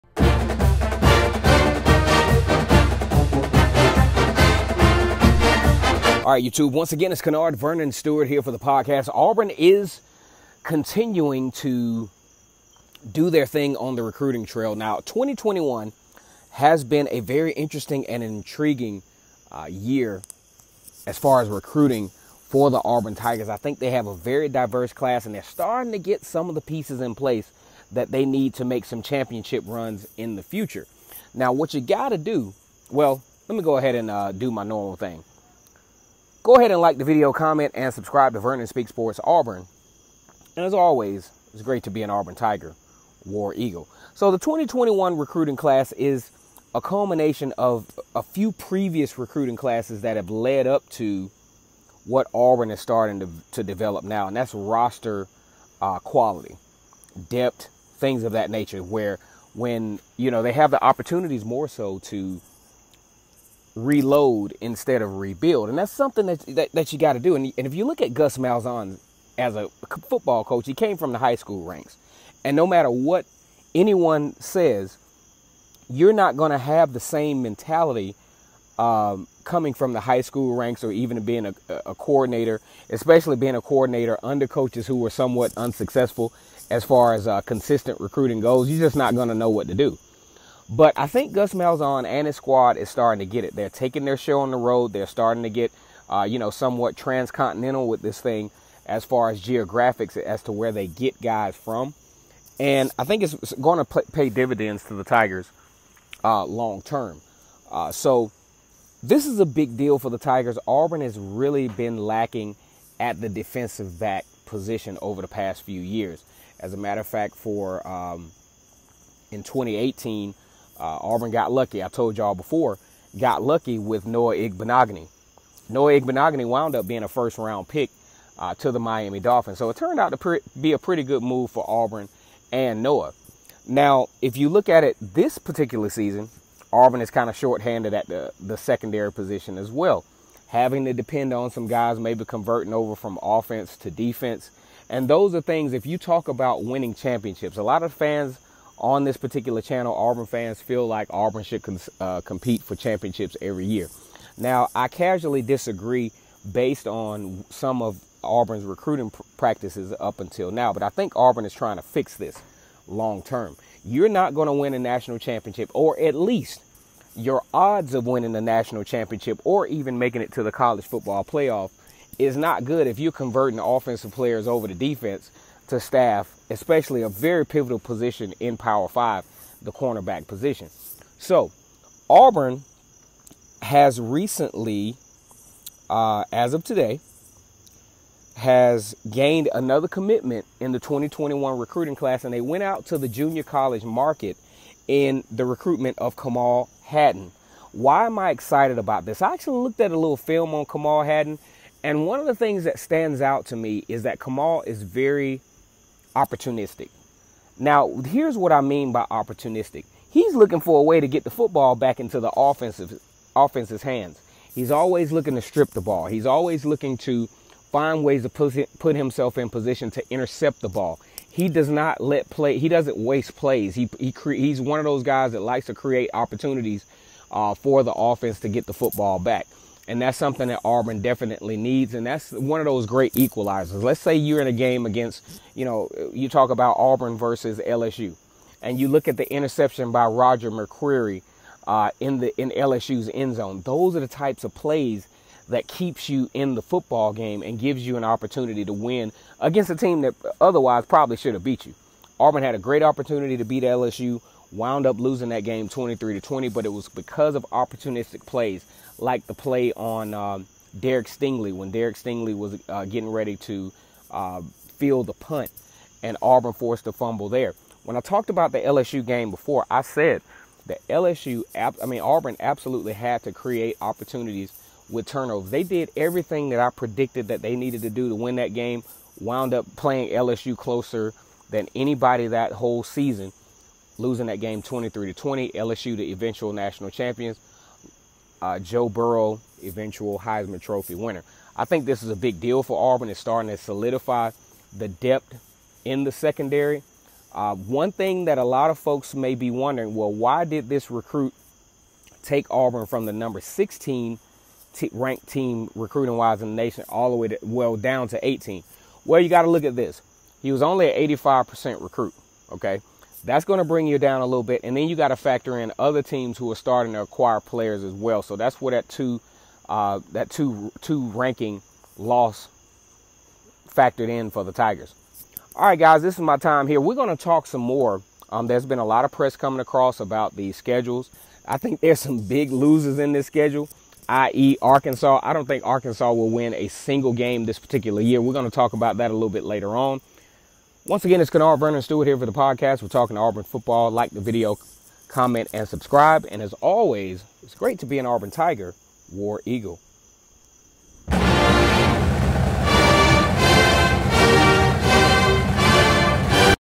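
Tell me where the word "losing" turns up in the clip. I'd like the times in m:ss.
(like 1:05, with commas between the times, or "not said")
4:14, 4:43.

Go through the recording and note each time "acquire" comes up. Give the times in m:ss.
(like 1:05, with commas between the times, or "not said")
5:17.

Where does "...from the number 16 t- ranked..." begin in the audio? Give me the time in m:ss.
5:02.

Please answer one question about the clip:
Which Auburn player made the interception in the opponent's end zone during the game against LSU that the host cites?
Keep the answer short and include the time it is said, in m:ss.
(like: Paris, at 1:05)
Roger McCreary, at 4:00.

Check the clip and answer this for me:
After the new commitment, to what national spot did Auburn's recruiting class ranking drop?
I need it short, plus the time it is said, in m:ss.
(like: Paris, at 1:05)
18, at 5:08.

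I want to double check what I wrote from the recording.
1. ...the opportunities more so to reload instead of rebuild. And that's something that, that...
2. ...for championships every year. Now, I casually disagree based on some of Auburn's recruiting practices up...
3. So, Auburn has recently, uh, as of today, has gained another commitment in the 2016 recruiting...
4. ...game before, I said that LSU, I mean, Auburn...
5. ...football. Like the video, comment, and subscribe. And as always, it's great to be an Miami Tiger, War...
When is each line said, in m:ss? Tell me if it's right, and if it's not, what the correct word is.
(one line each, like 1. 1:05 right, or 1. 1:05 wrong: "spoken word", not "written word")
1. 1:00 right
2. 2:32 right
3. 3:01 wrong: "2021", not "2016"
4. 4:29 right
5. 5:43 wrong: "Auburn", not "Miami".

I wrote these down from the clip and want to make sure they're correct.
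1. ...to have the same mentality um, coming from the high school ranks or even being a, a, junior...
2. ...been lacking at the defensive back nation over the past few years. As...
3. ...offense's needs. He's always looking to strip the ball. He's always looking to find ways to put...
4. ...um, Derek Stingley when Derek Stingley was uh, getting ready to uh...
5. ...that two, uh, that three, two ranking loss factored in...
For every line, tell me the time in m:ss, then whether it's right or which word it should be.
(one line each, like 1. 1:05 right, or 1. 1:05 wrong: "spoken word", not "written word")
1. 1:16 wrong: "coordinator", not "junior"
2. 1:51 wrong: "position", not "nation"
3. 3:33 wrong: "hands", not "needs"
4. 4:20 right
5. 5:18 wrong: "two", not "three".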